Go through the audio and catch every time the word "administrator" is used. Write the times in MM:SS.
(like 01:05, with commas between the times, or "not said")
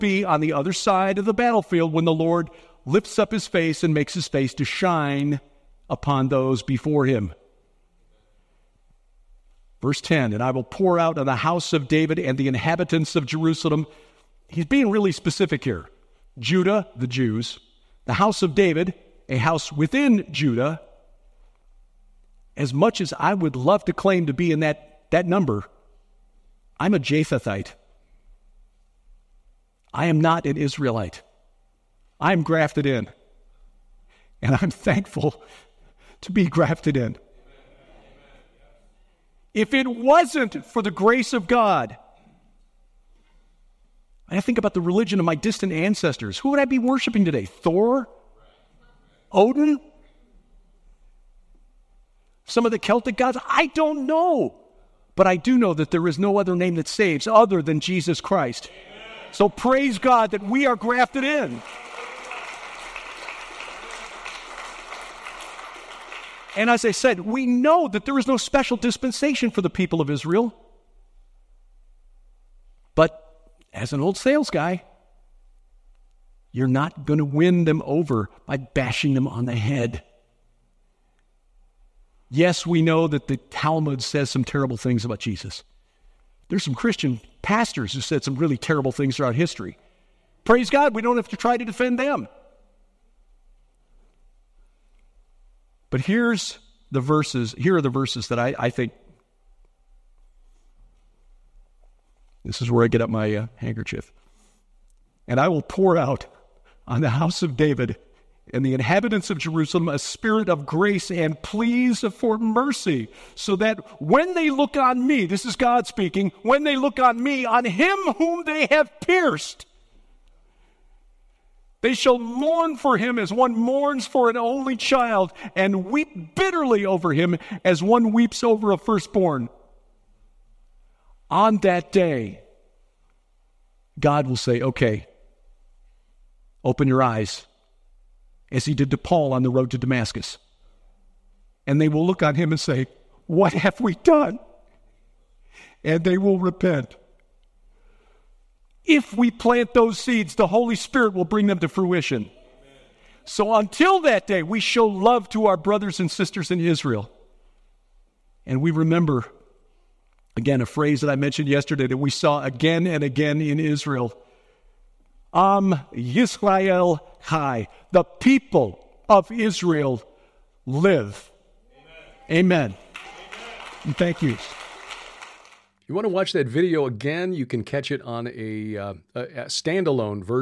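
not said.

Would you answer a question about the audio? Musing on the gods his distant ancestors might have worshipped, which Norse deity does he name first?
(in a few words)
Thor.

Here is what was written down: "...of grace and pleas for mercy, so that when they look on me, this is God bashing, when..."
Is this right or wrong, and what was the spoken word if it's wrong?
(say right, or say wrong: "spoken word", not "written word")
wrong: "speaking", not "bashing".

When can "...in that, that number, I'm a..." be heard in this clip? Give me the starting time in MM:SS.
00:24.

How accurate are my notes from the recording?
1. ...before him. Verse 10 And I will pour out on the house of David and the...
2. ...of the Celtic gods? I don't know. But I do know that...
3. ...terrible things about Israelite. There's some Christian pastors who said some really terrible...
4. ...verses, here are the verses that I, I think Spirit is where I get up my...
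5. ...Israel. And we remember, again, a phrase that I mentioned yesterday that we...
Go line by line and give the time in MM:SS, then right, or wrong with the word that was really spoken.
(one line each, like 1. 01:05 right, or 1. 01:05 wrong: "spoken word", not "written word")
1. 00:06 right
2. 00:52 right
3. 01:24 wrong: "Jesus", not "Israelite"
4. 01:36 wrong: "This", not "Spirit"
5. 02:36 right.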